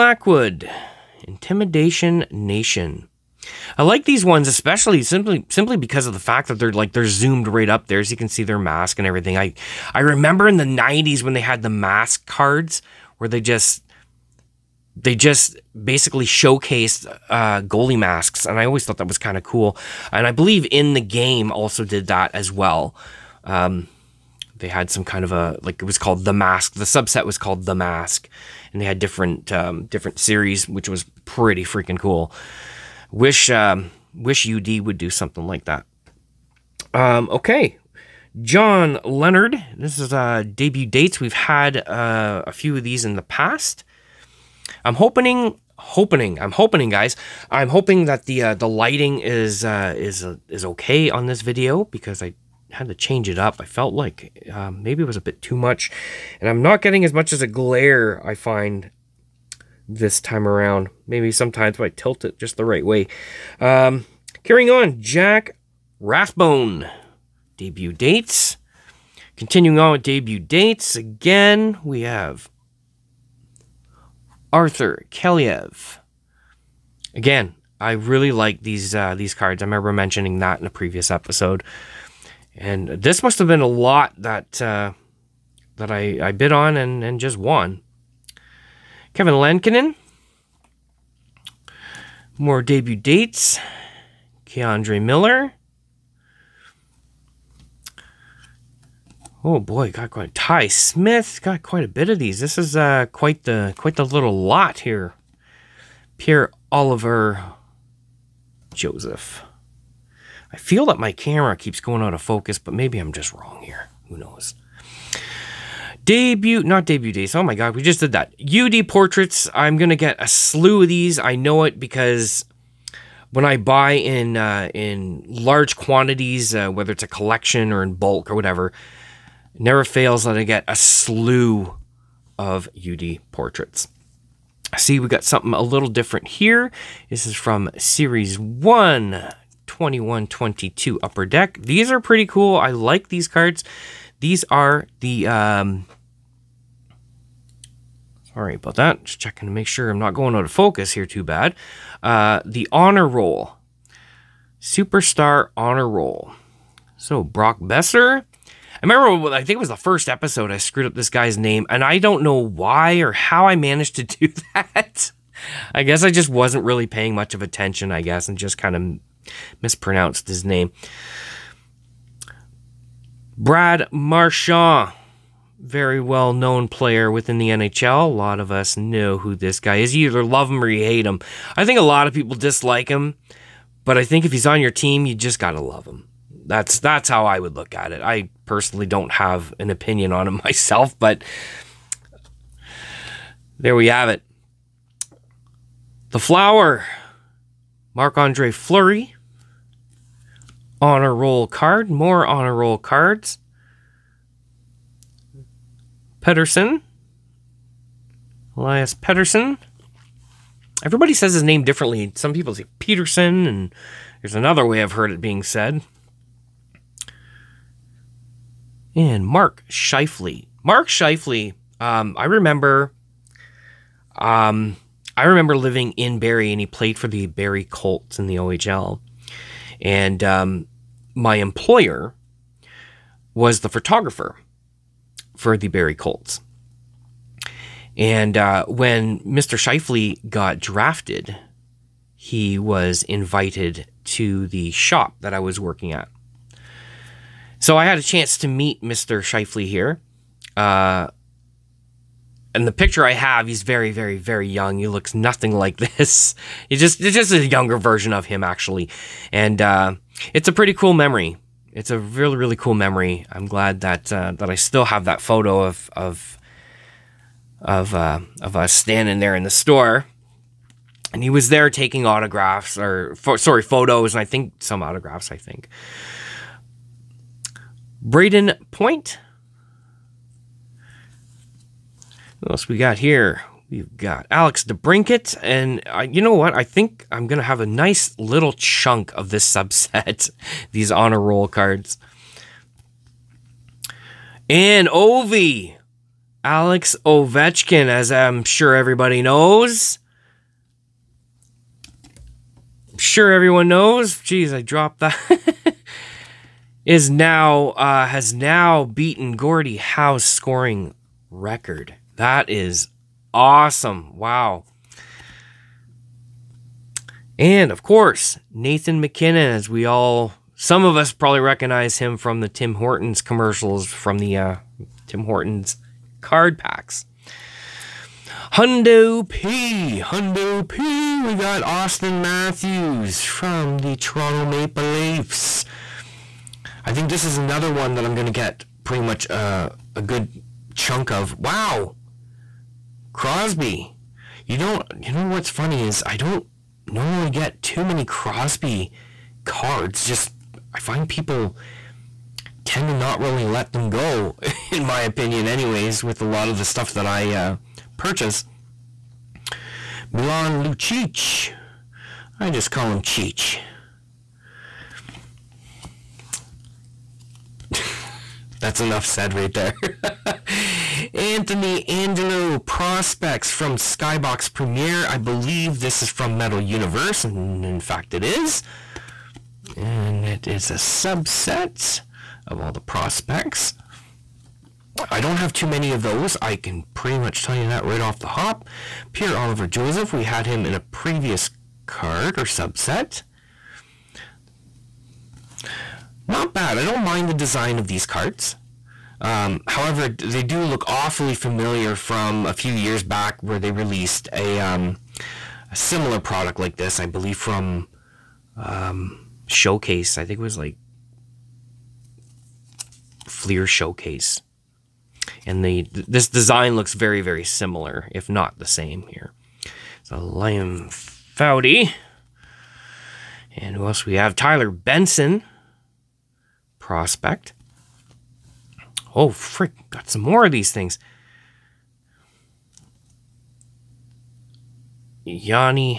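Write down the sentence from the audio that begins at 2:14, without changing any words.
See, we got something a little different here.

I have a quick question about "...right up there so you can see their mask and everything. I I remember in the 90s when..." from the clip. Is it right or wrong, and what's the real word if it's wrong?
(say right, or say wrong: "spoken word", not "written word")
right.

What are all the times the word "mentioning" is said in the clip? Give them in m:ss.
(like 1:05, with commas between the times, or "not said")
1:19.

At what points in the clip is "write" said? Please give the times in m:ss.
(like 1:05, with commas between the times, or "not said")
not said.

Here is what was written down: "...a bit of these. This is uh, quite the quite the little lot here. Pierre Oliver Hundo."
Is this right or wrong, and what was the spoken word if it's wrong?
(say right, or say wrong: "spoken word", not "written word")
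wrong: "Joseph", not "Hundo".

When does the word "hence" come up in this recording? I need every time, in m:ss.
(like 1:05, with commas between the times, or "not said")
not said.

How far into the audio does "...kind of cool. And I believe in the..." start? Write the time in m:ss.
0:19.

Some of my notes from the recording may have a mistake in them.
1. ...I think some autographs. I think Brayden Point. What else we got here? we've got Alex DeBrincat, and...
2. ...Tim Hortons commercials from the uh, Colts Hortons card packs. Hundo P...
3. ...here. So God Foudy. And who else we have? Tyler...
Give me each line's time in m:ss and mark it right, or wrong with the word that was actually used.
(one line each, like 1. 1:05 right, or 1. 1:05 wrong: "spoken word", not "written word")
1. 4:34 right
2. 5:22 wrong: "Tim", not "Colts"
3. 6:59 wrong: "Liam", not "God".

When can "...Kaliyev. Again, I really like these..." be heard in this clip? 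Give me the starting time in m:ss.
1:15.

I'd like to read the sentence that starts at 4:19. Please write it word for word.
And uh, it's a pretty cool memory it's a really really cool memory.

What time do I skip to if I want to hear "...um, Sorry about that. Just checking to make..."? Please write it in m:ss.
2:25.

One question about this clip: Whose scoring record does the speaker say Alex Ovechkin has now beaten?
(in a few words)
Gordie Howe.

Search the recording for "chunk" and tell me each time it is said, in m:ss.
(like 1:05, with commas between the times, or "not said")
4:48, 5:40.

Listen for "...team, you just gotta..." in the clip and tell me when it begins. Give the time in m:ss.
3:04.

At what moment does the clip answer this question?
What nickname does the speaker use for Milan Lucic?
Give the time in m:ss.
6:02.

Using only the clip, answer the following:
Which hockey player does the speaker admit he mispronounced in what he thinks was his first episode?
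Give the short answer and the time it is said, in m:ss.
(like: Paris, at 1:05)
Brock Boeser, at 2:37.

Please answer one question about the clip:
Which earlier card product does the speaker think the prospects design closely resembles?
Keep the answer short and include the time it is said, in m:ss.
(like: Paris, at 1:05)
Fleer Showcase, at 6:53.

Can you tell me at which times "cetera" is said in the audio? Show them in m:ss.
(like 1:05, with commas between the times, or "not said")
not said.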